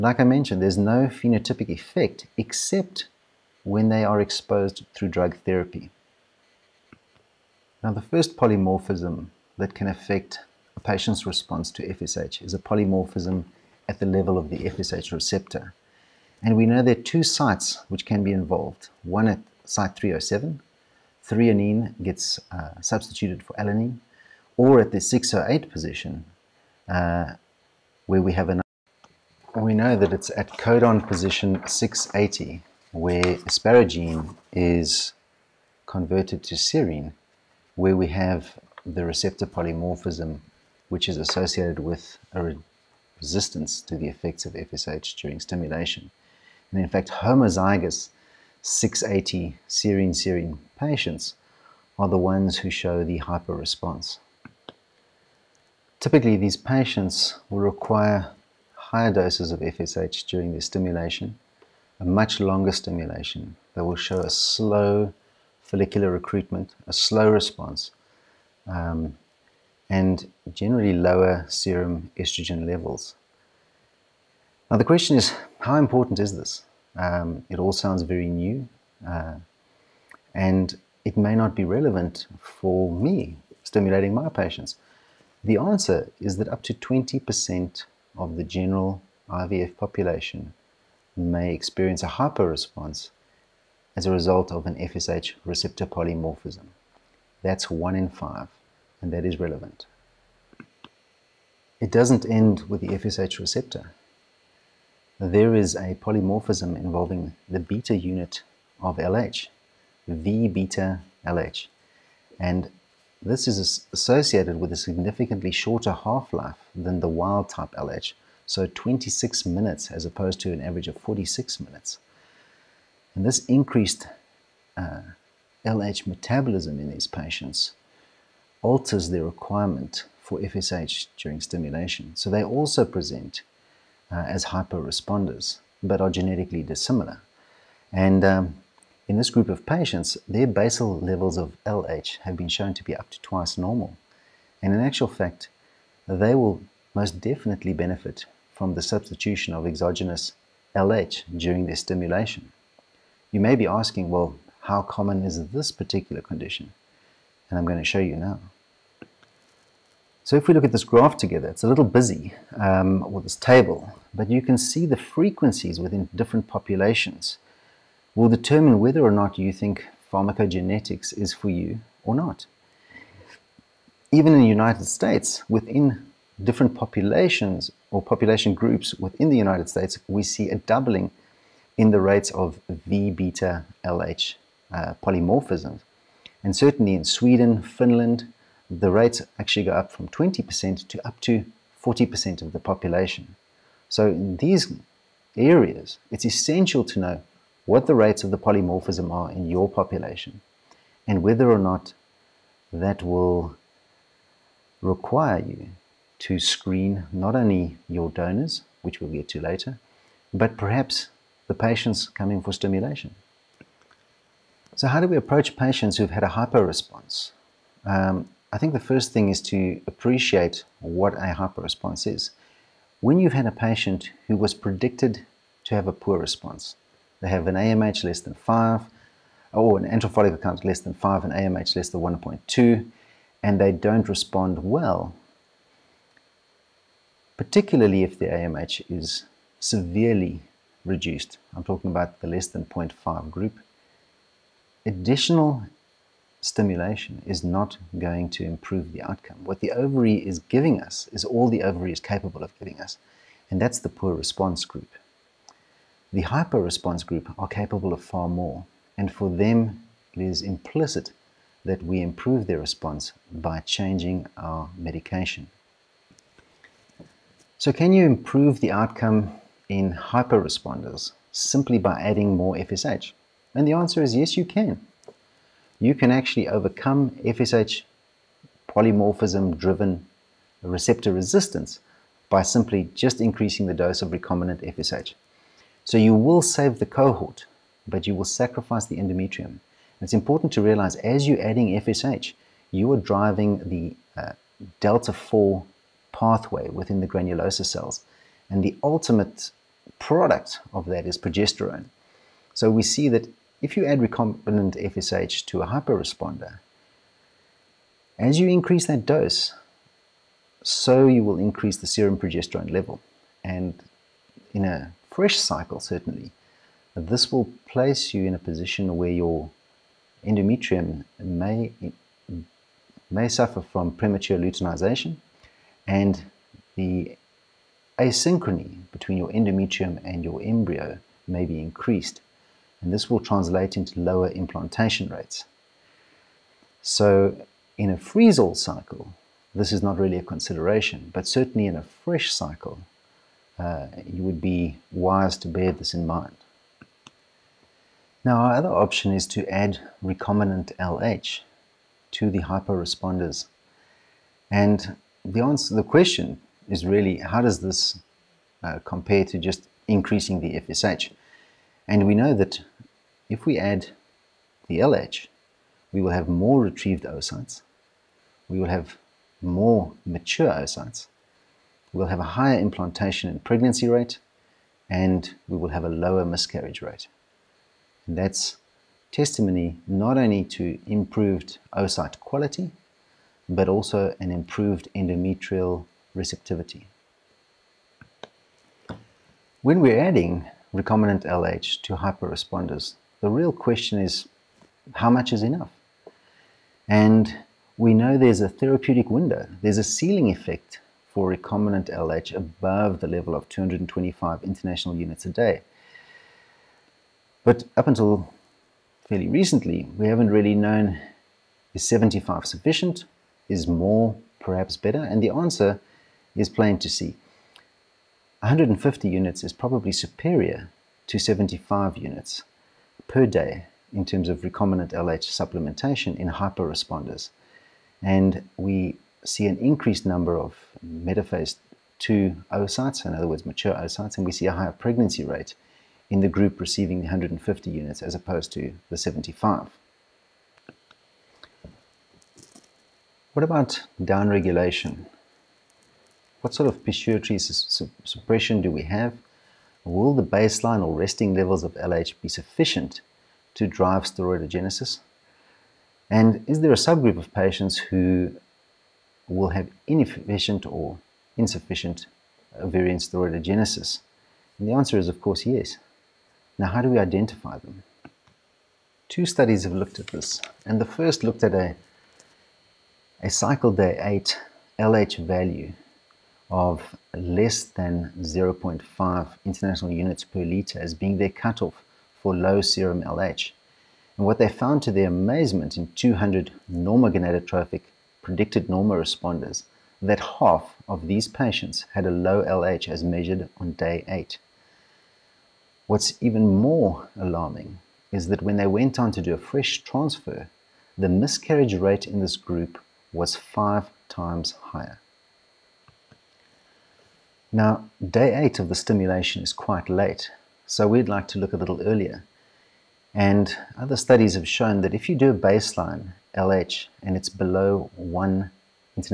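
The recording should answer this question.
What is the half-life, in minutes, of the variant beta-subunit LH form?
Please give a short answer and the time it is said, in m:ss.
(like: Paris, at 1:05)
26 minutes, at 1:58.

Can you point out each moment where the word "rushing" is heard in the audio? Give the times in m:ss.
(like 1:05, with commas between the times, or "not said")
not said.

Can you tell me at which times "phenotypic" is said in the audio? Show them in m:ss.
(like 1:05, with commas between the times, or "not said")
0:01.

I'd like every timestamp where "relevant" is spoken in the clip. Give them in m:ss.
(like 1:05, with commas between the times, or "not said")
1:21, 1:39.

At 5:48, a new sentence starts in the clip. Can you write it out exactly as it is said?
Now our other option is to add recombinant LH to the hyper responders.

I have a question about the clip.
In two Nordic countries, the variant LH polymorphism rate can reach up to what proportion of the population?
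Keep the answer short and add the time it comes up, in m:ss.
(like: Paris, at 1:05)
40%, at 3:11.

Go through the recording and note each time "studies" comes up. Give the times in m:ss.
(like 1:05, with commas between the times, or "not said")
7:49, 8:33.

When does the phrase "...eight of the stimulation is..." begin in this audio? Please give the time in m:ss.
8:28.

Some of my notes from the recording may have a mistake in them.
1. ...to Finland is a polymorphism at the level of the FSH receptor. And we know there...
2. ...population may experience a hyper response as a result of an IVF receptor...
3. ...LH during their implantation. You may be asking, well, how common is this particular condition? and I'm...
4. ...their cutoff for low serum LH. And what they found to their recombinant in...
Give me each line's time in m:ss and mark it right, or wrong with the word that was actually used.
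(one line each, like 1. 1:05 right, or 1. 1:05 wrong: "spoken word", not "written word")
1. 0:11 wrong: "FSH", not "Finland"
2. 1:29 wrong: "FSH", not "IVF"
3. 2:30 wrong: "stimulation", not "implantation"
4. 8:01 wrong: "amazement", not "recombinant".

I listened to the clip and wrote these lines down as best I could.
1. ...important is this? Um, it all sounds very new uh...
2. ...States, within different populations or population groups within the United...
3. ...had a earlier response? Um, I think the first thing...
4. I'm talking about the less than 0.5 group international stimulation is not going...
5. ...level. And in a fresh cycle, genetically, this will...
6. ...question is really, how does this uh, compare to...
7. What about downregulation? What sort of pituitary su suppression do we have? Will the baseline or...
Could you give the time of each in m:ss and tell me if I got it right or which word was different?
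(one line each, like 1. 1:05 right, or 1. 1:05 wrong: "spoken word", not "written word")
1. 1:15 right
2. 2:54 right
3. 3:36 wrong: "hyper", not "earlier"
4. 4:01 wrong: "additional", not "international"
5. 5:12 wrong: "certainly", not "genetically"
6. 5:55 right
7. 7:23 right.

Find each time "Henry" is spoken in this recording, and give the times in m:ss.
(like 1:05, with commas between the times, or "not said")
not said.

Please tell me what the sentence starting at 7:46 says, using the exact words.
Now, how do we identify them?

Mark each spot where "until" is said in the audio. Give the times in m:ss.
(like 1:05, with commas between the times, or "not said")
6:47.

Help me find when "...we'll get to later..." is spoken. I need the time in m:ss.
3:29.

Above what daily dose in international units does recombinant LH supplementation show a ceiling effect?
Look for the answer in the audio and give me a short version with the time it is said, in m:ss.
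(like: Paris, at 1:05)
225, at 6:43.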